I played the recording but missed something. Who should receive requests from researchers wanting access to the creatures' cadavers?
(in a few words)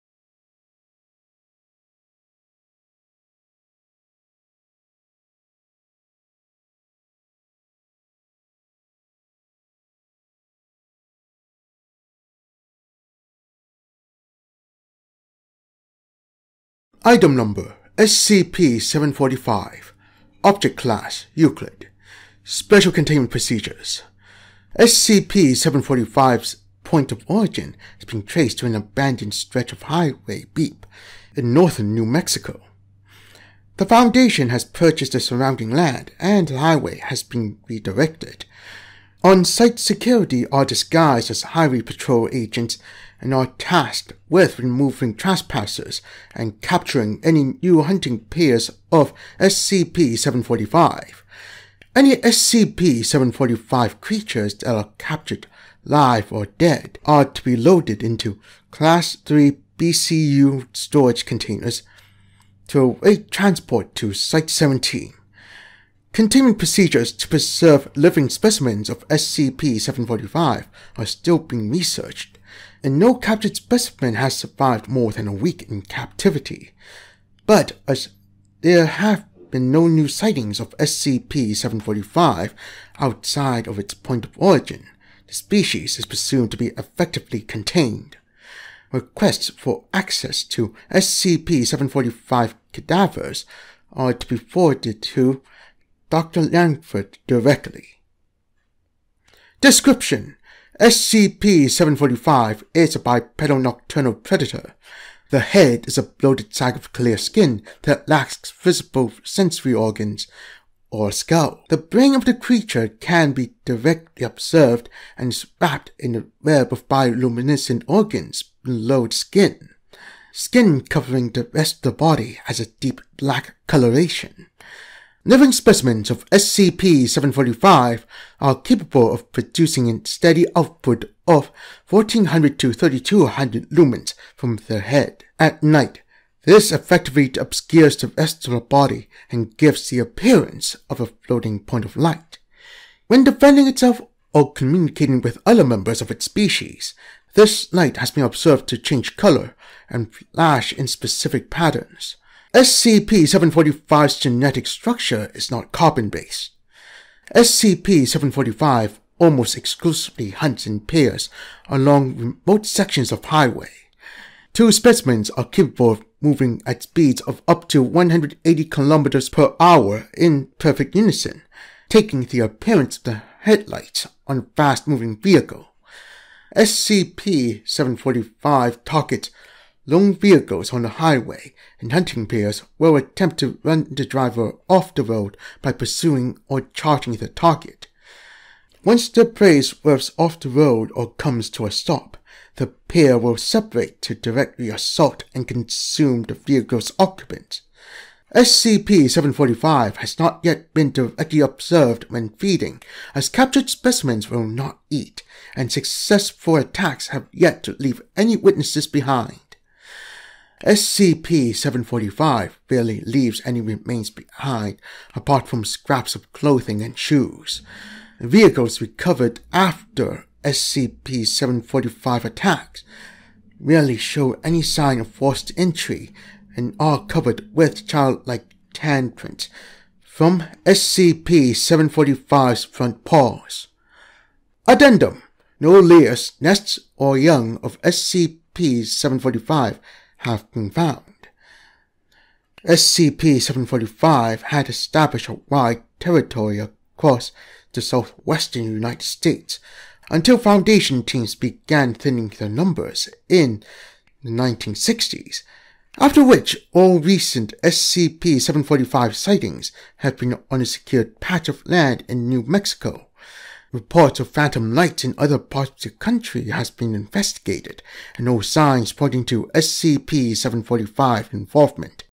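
Dr. Langford.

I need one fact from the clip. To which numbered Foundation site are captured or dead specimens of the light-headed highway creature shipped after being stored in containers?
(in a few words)
Site 17.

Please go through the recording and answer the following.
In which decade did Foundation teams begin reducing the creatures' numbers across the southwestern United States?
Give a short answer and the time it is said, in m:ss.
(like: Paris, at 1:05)
1960s, at 4:14.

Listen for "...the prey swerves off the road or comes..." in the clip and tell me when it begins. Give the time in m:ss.
3:09.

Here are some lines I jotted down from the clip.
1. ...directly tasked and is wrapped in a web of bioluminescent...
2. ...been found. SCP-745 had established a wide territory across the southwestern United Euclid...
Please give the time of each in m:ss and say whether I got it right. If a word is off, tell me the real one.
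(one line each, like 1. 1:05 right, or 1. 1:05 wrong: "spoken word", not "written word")
1. 1:53 wrong: "observed", not "tasked"
2. 4:00 wrong: "States", not "Euclid".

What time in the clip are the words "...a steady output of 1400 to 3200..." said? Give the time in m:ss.
2:09.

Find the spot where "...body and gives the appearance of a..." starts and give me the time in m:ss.
2:18.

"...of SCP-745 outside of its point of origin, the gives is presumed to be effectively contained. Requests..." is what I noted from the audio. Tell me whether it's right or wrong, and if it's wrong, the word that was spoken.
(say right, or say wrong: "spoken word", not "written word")
wrong: "species", not "gives".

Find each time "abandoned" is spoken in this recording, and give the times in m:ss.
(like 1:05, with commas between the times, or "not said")
0:28.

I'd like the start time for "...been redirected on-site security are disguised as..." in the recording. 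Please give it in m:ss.
0:37.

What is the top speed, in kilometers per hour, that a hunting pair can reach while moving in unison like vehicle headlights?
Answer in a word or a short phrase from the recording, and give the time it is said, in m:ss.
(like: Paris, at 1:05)
180, at 2:47.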